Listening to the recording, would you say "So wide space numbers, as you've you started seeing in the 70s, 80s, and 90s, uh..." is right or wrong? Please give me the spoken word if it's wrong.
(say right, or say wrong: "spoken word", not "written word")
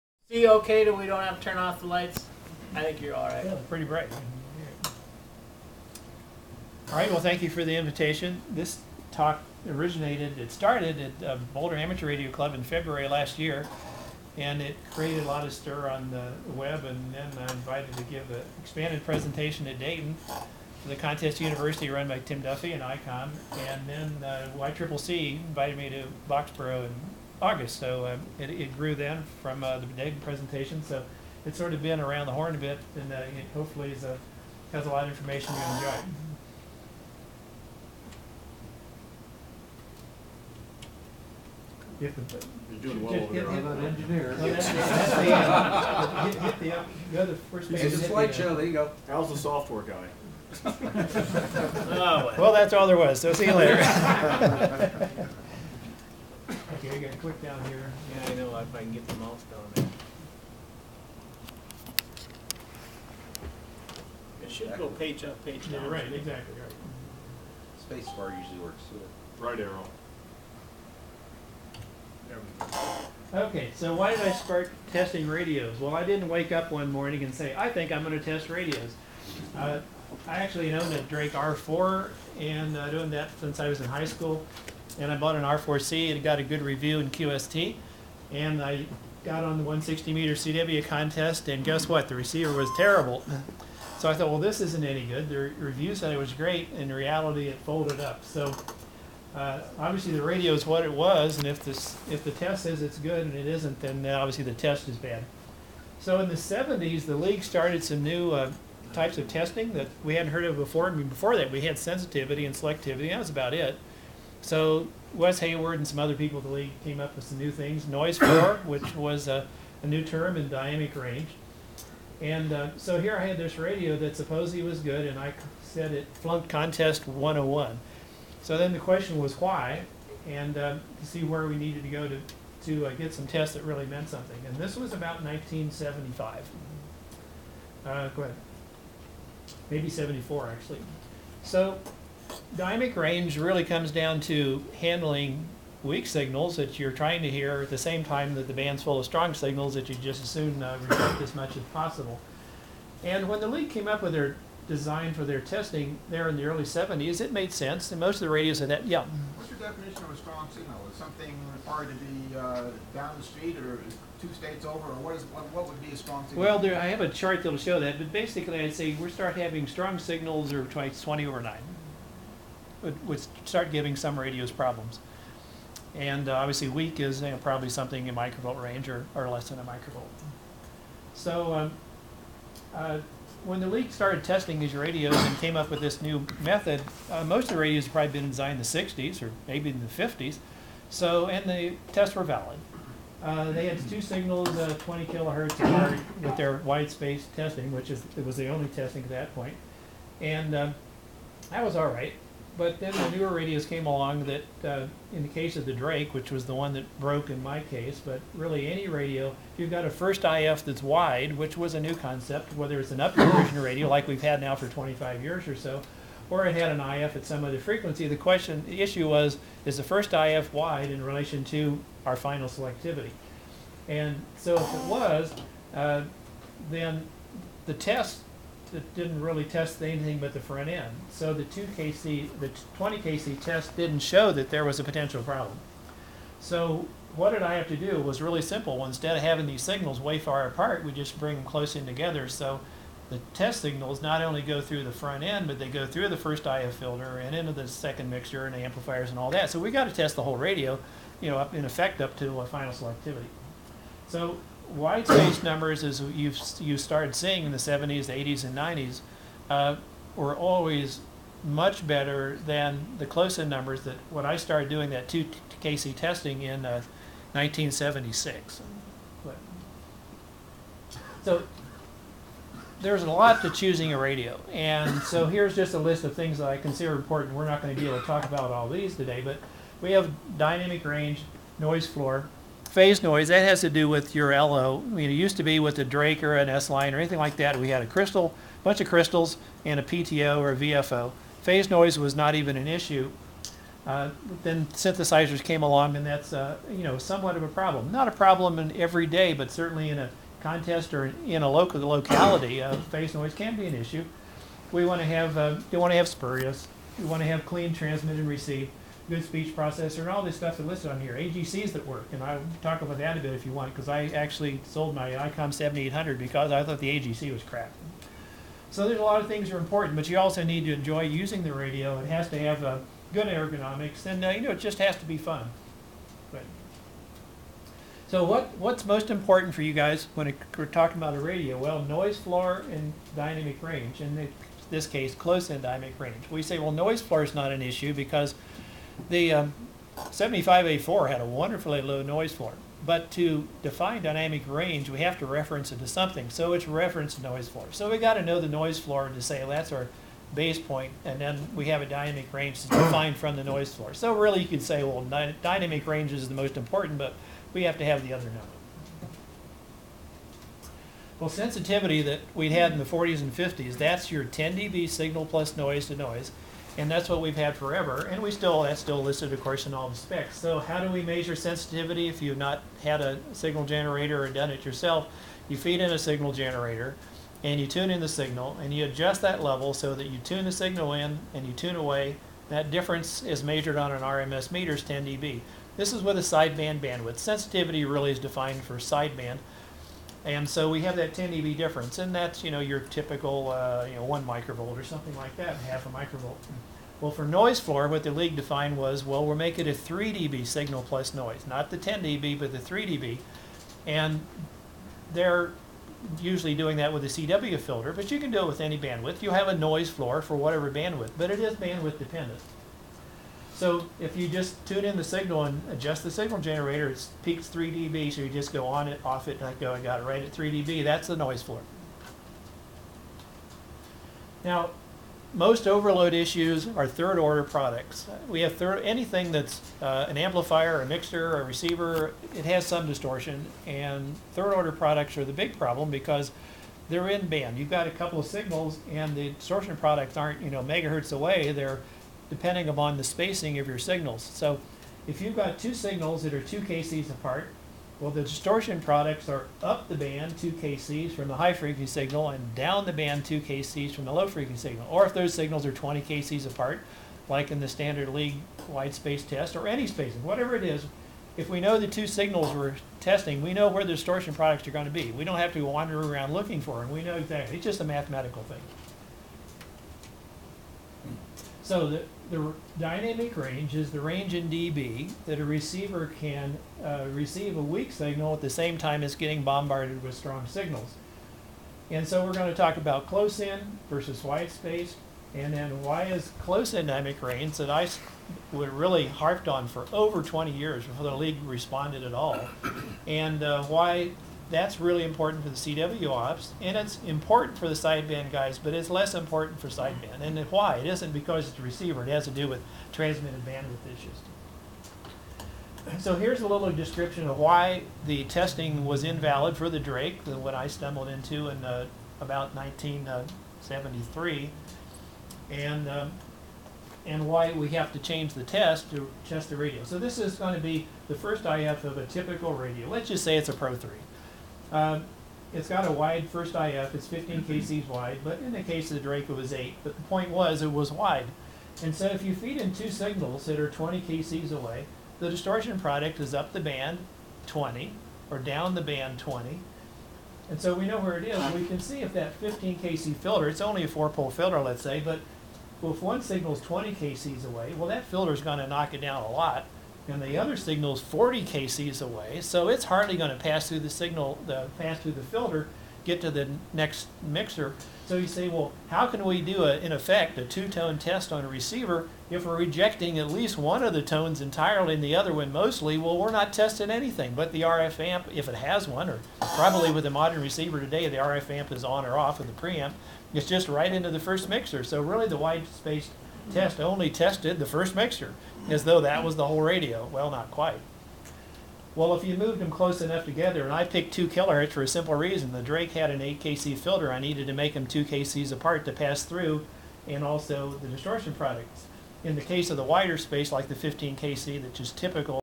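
right.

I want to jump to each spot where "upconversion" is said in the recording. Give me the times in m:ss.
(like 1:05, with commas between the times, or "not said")
3:32.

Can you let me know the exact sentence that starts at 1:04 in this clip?
It should go page up, page down.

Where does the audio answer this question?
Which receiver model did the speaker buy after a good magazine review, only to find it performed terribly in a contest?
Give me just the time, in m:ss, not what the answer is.
1:25.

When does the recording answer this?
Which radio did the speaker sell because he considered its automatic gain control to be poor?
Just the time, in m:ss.
5:15.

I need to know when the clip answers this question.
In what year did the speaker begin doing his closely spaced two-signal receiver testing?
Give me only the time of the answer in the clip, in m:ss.
4:27.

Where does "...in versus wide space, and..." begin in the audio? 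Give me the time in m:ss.
8:03.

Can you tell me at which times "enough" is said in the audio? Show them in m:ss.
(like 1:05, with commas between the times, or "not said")
9:43.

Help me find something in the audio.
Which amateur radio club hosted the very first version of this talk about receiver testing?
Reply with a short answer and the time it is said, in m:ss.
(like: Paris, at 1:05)
Boulder Amateur Radio Club, at 0:11.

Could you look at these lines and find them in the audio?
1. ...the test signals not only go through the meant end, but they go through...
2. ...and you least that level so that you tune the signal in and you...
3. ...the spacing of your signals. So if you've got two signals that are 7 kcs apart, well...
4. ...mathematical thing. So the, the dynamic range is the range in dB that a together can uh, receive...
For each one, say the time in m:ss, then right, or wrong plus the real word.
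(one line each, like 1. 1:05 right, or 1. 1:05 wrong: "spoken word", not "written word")
1. 4:03 wrong: "front", not "meant"
2. 6:18 wrong: "adjust", not "least"
3. 7:22 wrong: "2", not "7"
4. 7:47 wrong: "receiver", not "together".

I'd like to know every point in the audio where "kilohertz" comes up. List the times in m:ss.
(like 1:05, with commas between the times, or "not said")
3:15, 9:44.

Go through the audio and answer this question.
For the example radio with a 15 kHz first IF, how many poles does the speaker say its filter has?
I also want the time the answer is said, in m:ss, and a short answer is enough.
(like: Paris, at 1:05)
four, at 9:03.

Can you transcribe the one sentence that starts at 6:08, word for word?
And we still that's still listed, of course, in all the specs.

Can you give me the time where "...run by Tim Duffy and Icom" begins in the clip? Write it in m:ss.
0:21.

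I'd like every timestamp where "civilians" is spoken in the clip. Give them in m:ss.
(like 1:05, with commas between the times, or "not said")
not said.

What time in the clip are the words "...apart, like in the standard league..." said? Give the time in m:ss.
7:36.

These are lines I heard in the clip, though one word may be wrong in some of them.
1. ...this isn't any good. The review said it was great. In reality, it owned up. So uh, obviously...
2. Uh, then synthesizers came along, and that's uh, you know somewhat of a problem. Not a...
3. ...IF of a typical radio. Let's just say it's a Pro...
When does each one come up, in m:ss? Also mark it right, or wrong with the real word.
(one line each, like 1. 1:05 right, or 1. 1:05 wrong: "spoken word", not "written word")
1. 1:34 wrong: "folded", not "owned"
2. 4:53 right
3. 8:41 right.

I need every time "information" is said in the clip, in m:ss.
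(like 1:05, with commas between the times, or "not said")
0:35.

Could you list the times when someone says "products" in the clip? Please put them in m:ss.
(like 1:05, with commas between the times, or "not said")
7:07, 7:14, 7:19, 7:28, 7:44, 8:55, 9:51.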